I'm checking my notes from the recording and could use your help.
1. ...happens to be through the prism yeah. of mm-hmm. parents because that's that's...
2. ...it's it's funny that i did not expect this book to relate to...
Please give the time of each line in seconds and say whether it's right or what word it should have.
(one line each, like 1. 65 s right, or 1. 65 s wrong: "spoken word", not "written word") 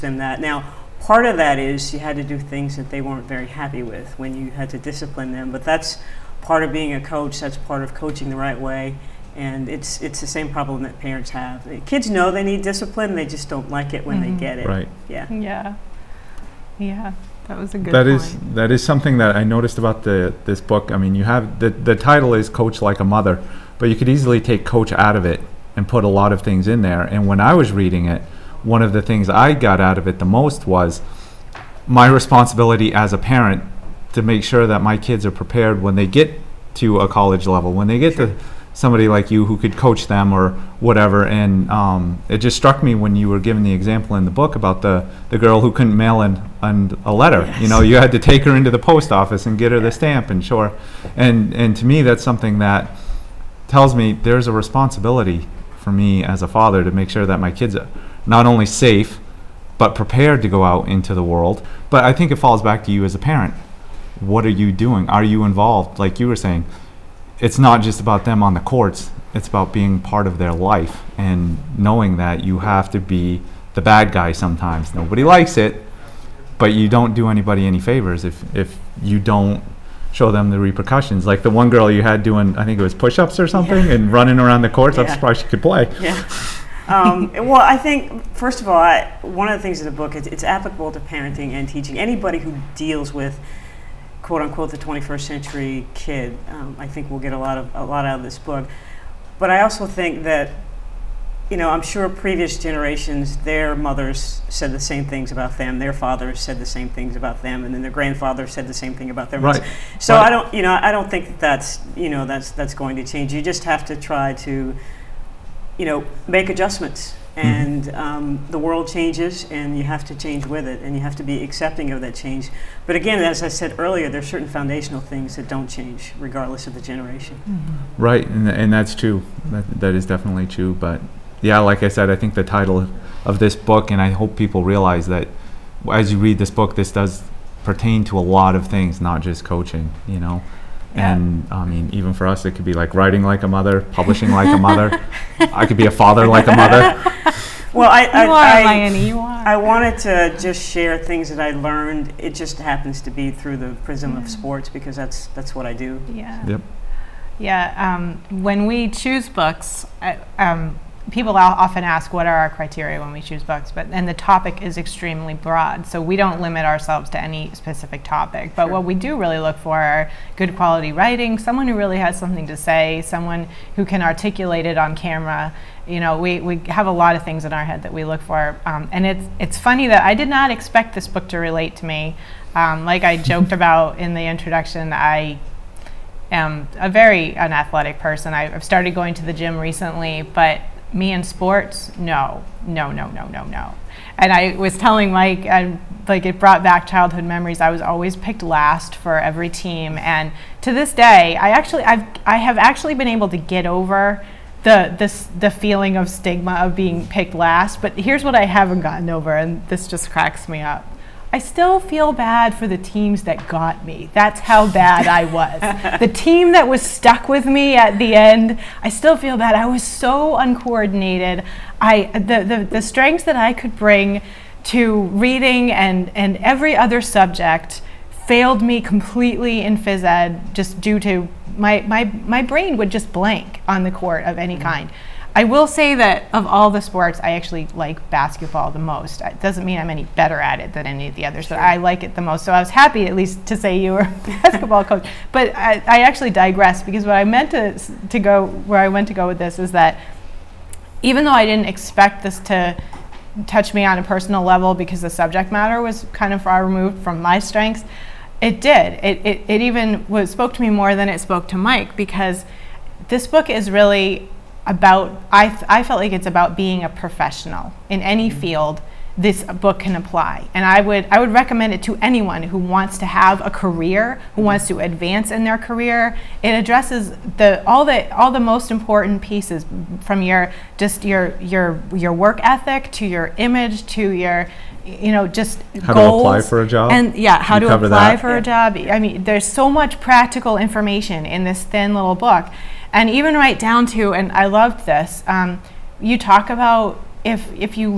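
1. 152 s wrong: "sports", not "parents"
2. 179 s right.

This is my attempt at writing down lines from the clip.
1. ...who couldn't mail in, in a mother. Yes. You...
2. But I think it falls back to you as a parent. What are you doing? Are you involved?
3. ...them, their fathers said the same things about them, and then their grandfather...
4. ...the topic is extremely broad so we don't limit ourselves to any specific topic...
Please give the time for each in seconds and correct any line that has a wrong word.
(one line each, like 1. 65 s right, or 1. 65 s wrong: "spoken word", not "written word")
1. 45 s wrong: "letter", not "mother"
2. 61 s right
3. 105 s right
4. 164 s right.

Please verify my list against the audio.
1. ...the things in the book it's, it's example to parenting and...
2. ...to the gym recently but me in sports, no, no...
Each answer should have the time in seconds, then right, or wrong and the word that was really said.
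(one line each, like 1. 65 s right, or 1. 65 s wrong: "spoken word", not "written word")
1. 89 s wrong: "applicable", not "example"
2. 189 s right.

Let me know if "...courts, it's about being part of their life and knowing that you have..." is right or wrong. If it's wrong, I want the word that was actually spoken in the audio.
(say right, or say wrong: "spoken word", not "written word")
right.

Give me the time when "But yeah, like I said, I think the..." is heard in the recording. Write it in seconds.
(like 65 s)
130 s.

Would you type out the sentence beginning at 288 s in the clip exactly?
I mean, there's so much practical information in this thin little book and even right down to, and I loved this.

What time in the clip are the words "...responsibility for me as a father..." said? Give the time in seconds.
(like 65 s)
54 s.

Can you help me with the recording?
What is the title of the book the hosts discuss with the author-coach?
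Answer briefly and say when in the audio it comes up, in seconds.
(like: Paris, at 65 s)
Coach Like a Mother, at 22 s.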